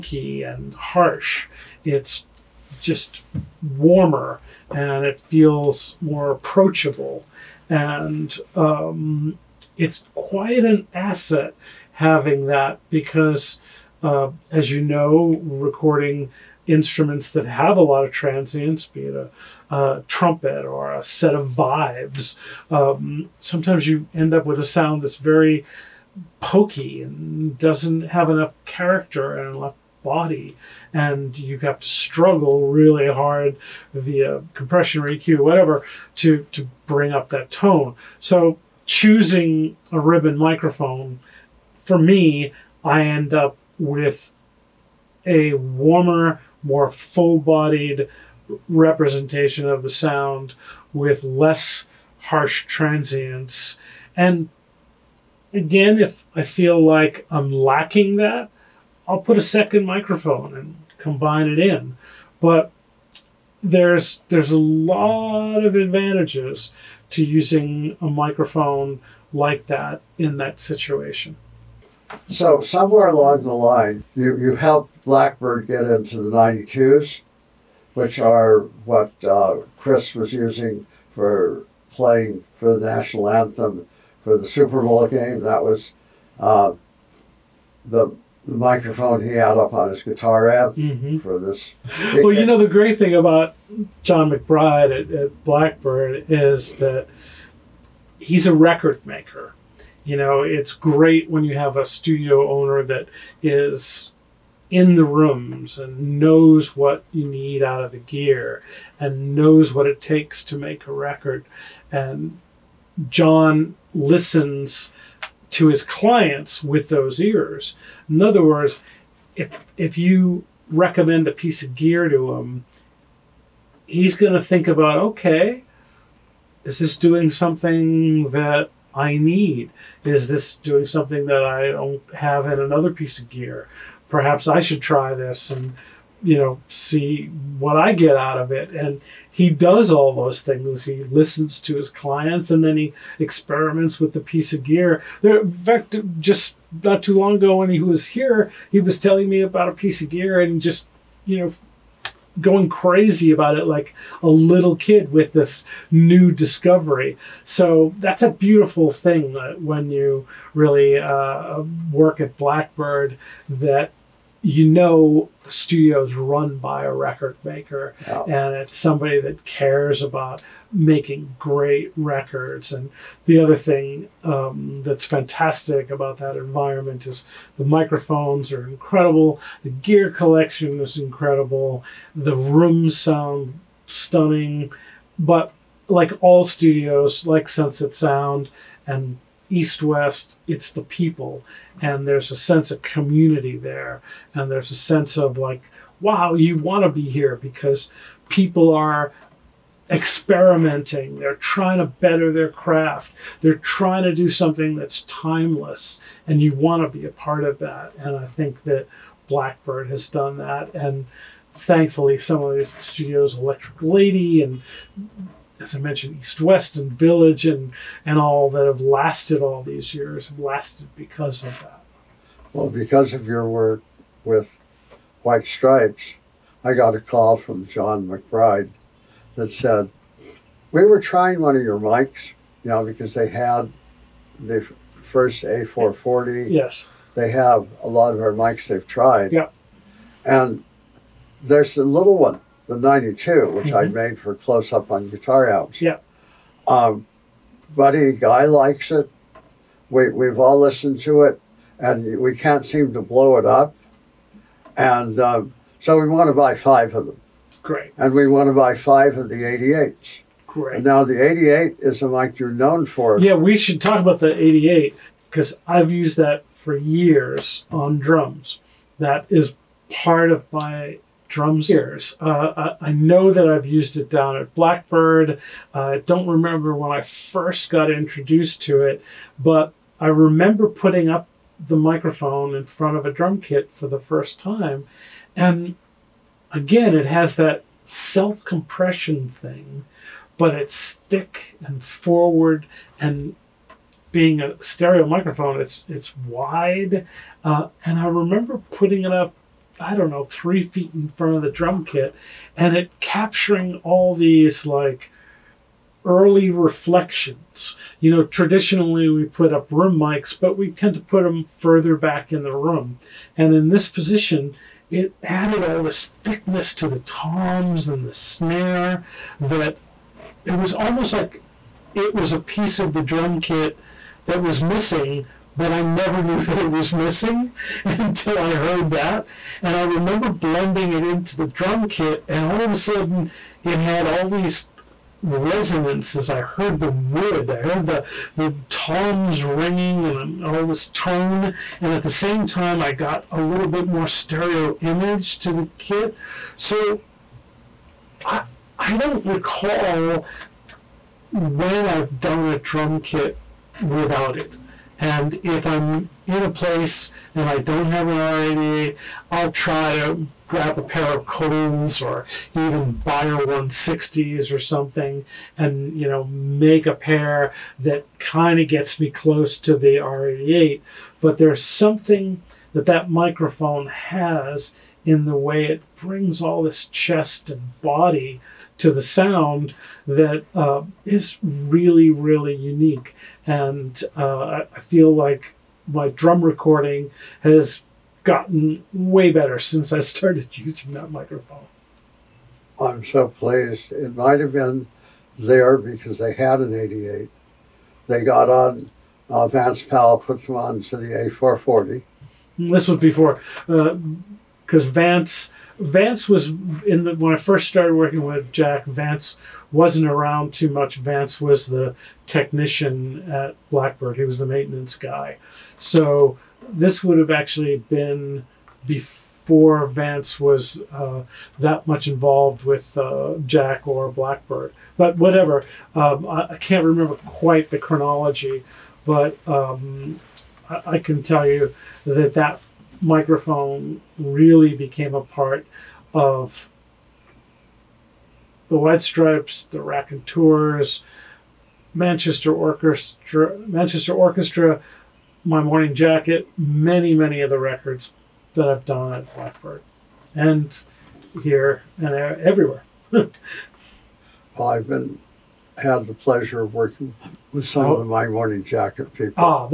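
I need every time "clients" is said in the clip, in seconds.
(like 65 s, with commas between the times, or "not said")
115 s, 141 s.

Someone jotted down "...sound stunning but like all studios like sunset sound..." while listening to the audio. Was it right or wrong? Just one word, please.
right.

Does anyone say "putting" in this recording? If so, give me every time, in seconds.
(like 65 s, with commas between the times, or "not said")
280 s, 298 s.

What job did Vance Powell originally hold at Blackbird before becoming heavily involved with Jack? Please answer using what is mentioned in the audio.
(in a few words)
Maintenance guy.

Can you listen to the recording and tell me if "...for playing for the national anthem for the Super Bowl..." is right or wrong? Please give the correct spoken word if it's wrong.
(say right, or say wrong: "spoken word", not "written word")
right.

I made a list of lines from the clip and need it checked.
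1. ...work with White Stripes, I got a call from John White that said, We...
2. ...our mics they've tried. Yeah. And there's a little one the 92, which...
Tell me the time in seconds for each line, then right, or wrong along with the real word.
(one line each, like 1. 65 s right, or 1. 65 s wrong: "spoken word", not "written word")
1. 223 s wrong: "McBride", not "White"
2. 238 s right.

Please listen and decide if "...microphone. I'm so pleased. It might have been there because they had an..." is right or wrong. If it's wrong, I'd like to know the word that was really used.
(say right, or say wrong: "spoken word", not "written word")
right.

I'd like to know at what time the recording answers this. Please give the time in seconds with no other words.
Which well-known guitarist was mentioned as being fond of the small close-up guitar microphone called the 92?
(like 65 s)
247 s.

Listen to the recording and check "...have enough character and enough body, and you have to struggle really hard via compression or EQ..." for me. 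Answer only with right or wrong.
right.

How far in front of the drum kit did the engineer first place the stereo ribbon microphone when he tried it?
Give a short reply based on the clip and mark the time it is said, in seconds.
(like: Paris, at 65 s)
3 feet, at 300 s.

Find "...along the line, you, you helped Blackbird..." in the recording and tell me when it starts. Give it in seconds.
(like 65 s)
73 s.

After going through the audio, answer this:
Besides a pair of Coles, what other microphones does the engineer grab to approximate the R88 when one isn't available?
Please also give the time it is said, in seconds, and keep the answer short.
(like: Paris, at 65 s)
Beyer 160s, at 363 s.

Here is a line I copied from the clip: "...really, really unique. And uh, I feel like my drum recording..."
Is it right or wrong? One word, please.
right.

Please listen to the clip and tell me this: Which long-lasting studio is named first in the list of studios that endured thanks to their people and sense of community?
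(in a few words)
Electric Lady.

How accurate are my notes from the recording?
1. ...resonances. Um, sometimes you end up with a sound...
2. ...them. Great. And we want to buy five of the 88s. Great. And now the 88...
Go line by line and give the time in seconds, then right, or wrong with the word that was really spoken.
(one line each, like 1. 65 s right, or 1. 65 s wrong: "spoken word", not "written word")
1. 21 s wrong: "vibes", not "resonances"
2. 257 s right.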